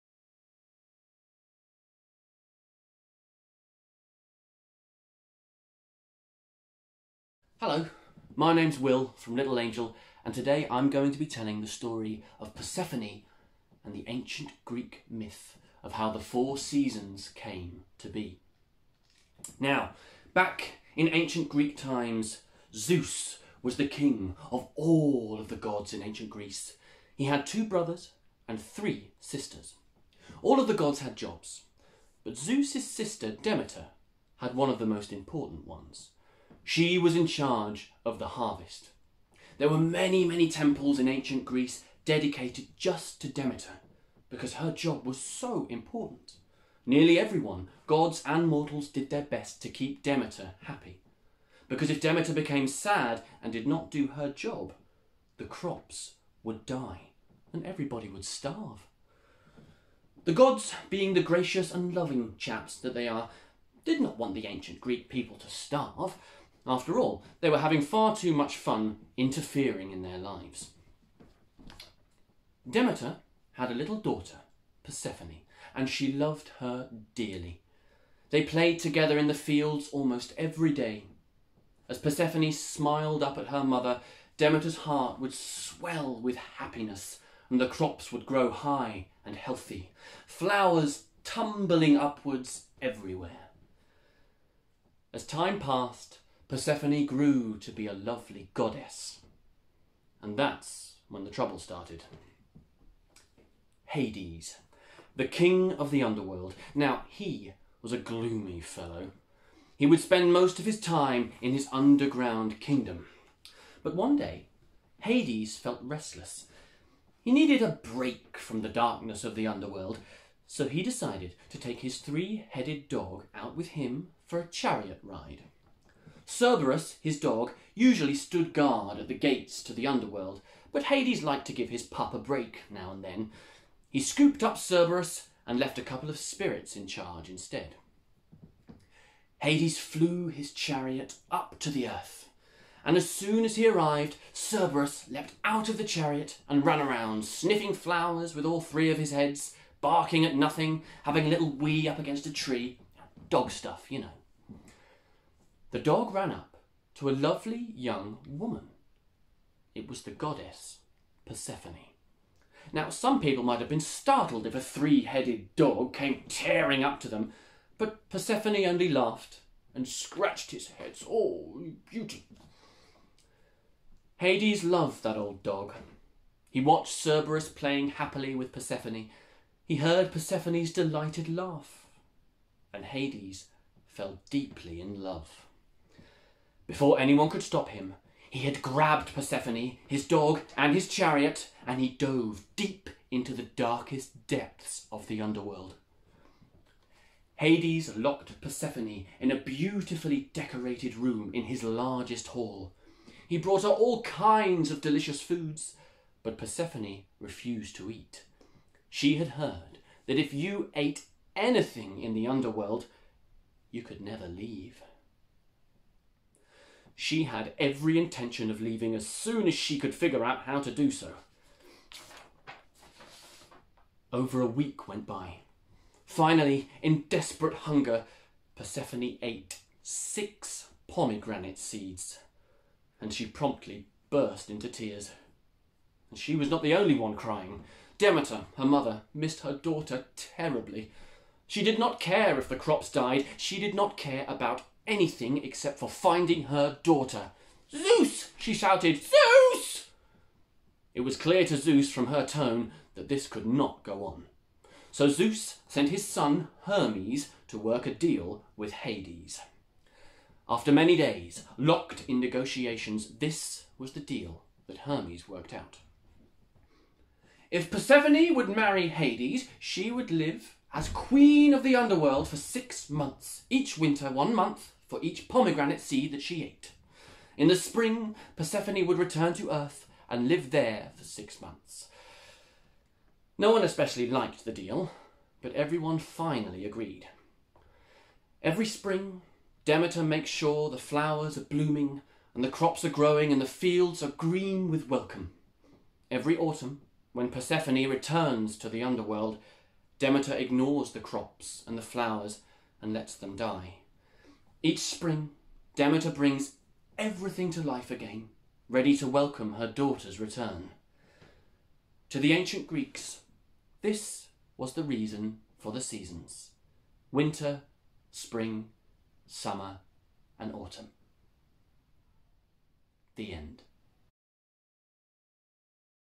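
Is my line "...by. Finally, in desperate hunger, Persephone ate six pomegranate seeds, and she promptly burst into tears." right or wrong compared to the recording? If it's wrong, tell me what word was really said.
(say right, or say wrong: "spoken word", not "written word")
right.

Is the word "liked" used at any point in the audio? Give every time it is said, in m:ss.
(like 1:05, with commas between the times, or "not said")
2:11, 4:44.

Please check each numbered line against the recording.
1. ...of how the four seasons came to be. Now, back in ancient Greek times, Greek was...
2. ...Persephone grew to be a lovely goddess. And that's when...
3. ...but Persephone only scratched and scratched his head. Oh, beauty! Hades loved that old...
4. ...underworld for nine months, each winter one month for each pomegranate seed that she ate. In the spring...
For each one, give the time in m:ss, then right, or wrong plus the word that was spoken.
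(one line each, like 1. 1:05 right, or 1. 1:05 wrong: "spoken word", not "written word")
1. 0:15 wrong: "Zeus", not "Greek"
2. 1:36 right
3. 2:47 wrong: "laughed", not "scratched"
4. 4:31 wrong: "six", not "nine".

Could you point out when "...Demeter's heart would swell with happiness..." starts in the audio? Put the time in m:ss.
1:24.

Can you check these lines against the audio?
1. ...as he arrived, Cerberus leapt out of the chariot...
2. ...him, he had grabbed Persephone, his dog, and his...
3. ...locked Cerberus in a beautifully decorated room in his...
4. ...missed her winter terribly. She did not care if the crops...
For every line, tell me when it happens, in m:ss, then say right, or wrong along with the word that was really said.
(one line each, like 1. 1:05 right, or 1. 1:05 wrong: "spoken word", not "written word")
1. 2:23 right
2. 3:07 right
3. 3:17 wrong: "Persephone", not "Cerberus"
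4. 3:59 wrong: "daughter", not "winter".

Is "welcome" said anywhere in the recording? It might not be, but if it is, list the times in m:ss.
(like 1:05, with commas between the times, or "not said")
4:54, 5:09.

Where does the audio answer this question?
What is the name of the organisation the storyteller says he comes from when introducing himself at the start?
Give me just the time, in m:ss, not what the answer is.
0:09.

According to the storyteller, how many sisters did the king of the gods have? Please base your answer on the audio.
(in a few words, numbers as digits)
3.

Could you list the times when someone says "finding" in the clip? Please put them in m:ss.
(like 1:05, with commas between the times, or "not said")
4:05.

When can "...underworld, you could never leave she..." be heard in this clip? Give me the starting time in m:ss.
3:32.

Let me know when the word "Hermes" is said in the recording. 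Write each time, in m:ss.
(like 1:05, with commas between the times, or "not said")
4:16, 4:24.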